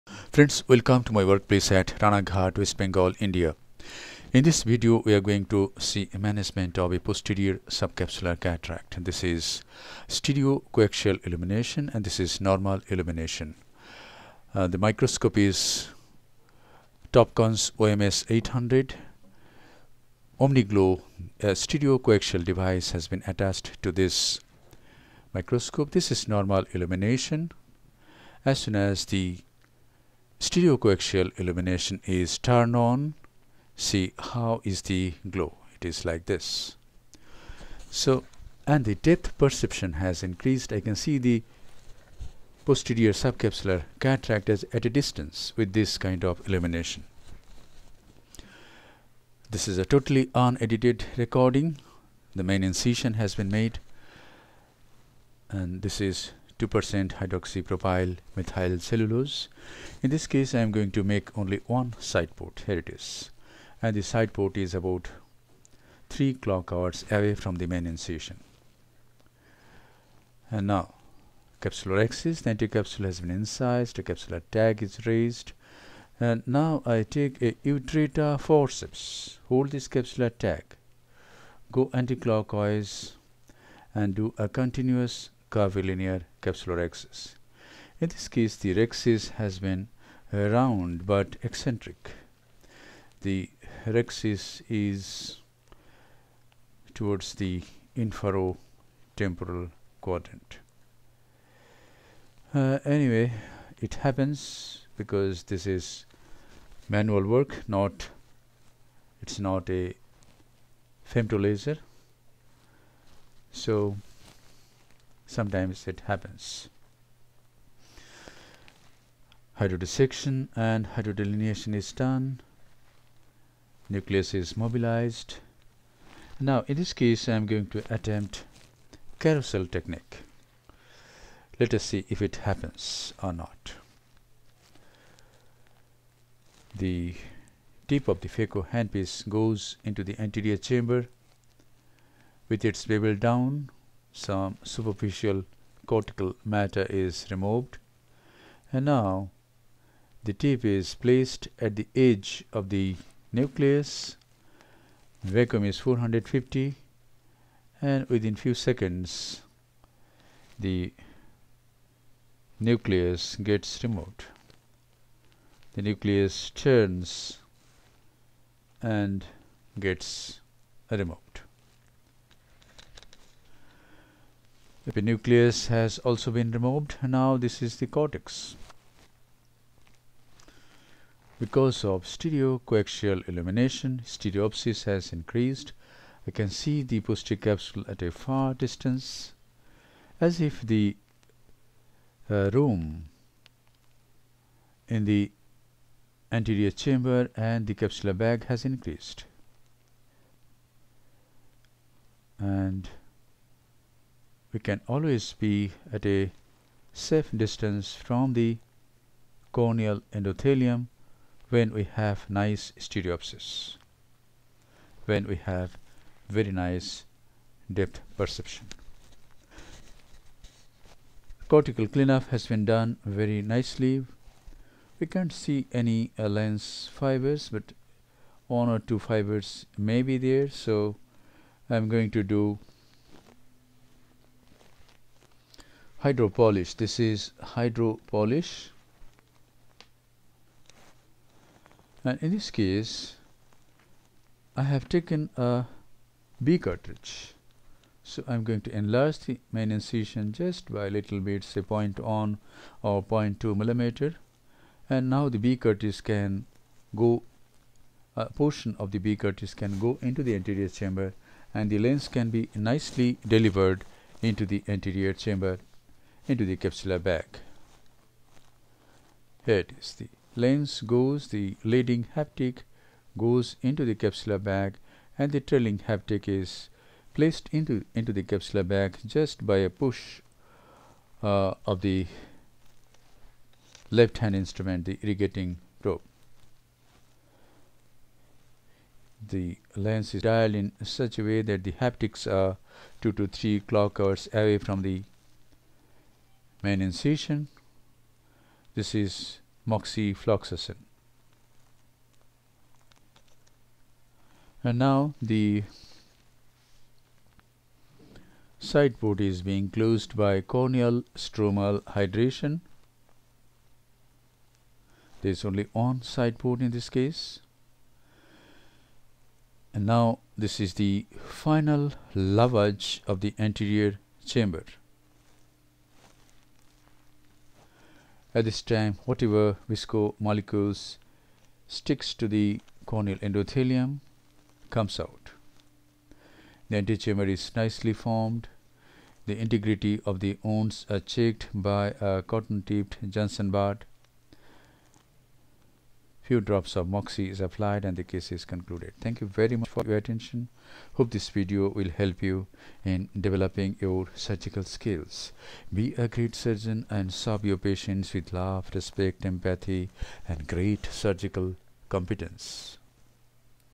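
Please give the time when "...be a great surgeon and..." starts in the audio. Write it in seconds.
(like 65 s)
355 s.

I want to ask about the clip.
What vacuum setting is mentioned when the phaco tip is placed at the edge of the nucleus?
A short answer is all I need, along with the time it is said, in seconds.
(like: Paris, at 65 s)
450, at 155 s.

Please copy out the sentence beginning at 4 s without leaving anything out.
In this video, we are going to see management of a posterior subcapsular cataract.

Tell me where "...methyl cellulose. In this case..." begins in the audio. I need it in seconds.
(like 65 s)
58 s.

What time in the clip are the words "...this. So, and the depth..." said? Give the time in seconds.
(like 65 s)
36 s.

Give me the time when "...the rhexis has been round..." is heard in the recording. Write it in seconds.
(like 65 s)
88 s.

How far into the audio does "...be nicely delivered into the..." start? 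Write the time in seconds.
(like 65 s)
262 s.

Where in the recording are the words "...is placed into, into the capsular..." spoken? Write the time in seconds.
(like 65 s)
276 s.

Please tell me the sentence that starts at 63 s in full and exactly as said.
And the side port is about 3 clock hours away from the main incision.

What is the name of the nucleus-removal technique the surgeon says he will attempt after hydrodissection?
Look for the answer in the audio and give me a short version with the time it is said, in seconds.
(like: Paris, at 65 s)
carousel technique, at 129 s.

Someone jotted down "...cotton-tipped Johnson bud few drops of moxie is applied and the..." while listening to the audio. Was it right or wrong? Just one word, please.
right.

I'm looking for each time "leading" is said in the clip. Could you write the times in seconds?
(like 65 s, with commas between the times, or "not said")
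271 s.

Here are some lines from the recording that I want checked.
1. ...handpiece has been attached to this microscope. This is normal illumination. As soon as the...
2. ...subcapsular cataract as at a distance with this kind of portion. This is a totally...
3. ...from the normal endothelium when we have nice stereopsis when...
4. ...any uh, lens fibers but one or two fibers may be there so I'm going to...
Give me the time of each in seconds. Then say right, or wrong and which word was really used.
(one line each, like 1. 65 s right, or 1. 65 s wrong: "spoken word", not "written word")
1. 22 s wrong: "device", not "handpiece"
2. 43 s wrong: "illumination", not "portion"
3. 207 s wrong: "corneal", not "normal"
4. 225 s right.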